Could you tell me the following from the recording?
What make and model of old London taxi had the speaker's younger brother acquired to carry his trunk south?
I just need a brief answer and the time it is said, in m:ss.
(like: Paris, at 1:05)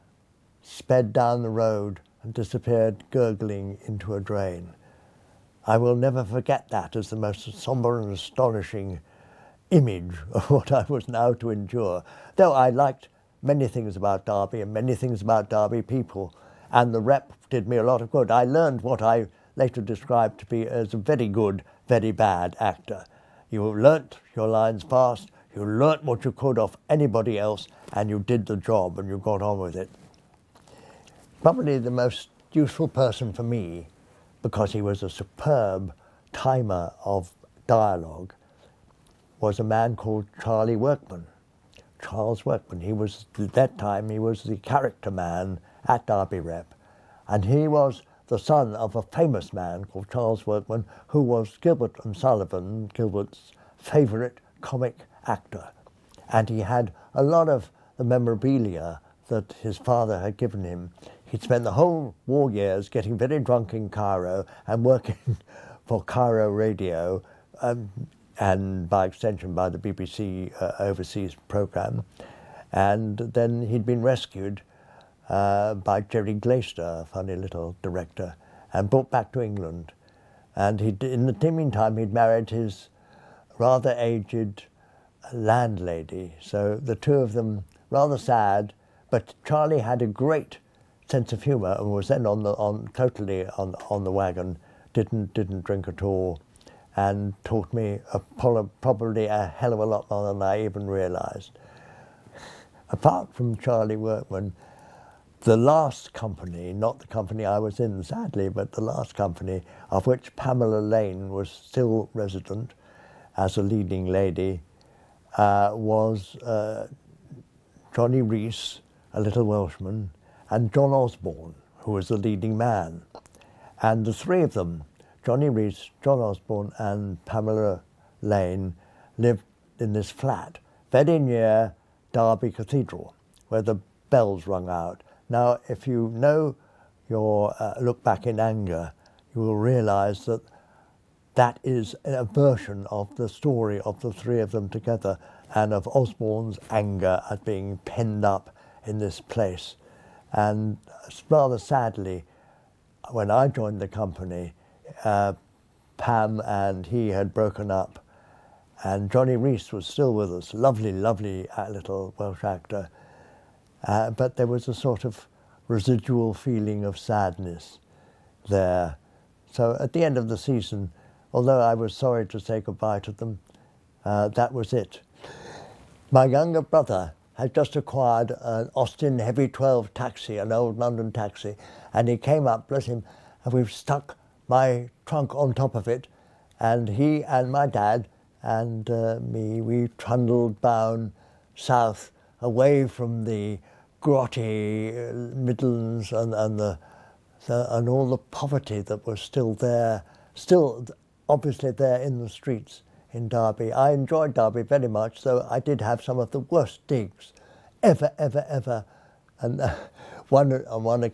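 Austin Heavy 12, at 2:58.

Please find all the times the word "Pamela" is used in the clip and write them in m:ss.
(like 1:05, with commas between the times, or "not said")
1:50, 2:07.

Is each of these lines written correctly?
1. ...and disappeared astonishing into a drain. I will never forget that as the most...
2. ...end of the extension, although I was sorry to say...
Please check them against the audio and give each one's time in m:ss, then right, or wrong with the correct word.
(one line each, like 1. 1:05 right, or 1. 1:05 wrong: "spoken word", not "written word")
1. 0:02 wrong: "gurgling", not "astonishing"
2. 2:50 wrong: "season", not "extension".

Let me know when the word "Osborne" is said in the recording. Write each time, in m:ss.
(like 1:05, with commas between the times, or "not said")
2:00, 2:06, 2:25.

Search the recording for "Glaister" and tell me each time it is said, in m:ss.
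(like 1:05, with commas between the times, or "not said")
1:16.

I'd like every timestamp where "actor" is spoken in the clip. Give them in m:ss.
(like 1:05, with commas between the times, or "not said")
0:22, 0:55, 2:42.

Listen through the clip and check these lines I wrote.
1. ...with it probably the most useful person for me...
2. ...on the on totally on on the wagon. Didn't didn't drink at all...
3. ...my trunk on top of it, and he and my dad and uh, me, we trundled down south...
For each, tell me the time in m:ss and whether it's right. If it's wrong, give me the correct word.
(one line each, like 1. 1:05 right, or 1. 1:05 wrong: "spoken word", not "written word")
1. 0:29 right
2. 1:32 right
3. 3:04 right.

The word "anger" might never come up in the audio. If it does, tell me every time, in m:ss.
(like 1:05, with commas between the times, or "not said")
2:18, 2:26.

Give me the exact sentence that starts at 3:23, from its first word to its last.
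I enjoyed Derby very much, though I did have some of the worst digs ever, ever, ever.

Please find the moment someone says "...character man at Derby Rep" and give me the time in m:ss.
0:44.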